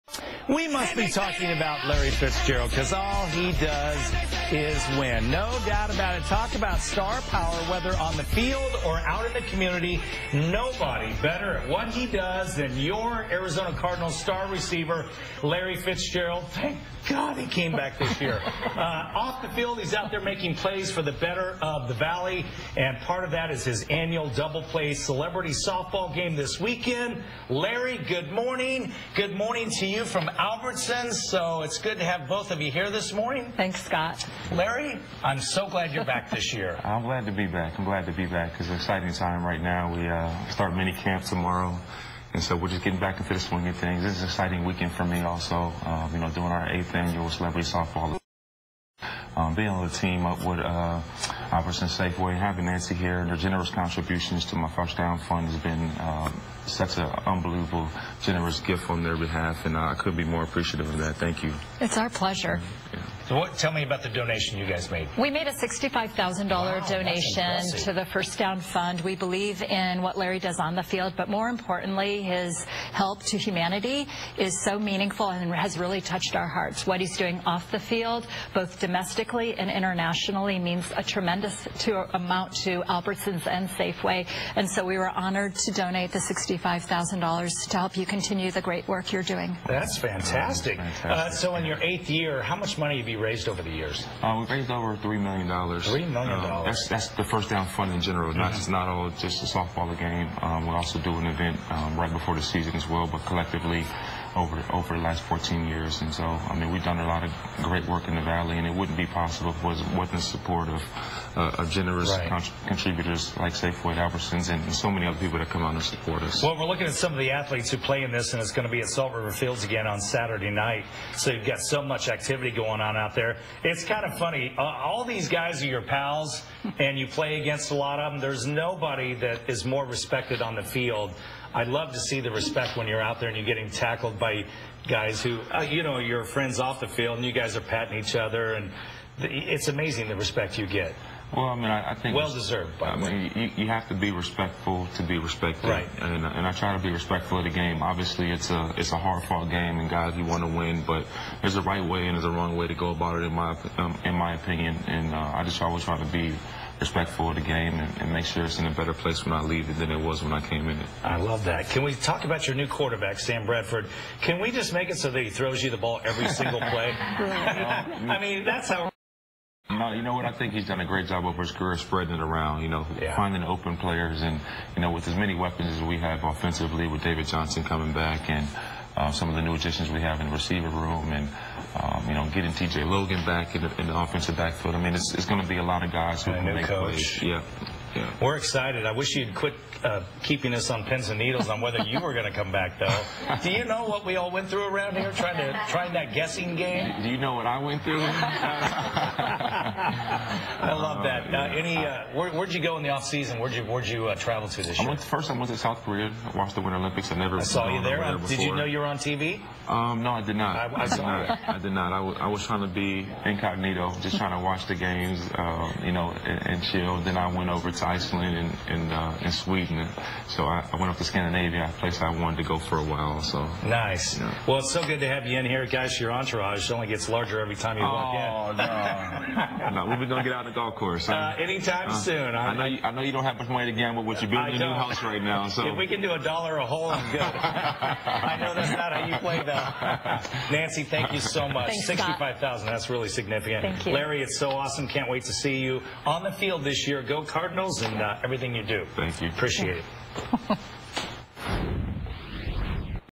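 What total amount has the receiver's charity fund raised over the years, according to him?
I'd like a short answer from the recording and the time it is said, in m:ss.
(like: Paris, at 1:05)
Over 3 million dollars, at 1:34.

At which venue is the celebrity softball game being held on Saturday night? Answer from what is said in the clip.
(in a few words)
Salt River Fields.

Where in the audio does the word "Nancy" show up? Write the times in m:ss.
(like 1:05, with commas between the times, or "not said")
0:52, 4:00.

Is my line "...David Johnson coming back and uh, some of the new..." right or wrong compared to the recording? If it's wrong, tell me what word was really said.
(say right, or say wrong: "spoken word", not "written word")
right.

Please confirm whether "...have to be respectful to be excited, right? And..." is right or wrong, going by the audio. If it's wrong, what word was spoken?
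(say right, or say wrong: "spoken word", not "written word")
wrong: "respected", not "excited".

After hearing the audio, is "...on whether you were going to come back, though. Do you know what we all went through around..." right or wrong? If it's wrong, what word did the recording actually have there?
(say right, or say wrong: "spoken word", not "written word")
right.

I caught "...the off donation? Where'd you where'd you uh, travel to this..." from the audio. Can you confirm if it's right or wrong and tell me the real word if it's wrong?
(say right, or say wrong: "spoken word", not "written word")
wrong: "season", not "donation".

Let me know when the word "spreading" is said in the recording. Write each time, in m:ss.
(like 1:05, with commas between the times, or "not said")
2:51.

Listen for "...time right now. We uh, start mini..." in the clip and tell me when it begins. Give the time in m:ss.
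0:39.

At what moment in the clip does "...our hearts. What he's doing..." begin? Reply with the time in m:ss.
1:16.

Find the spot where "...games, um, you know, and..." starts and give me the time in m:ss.
3:34.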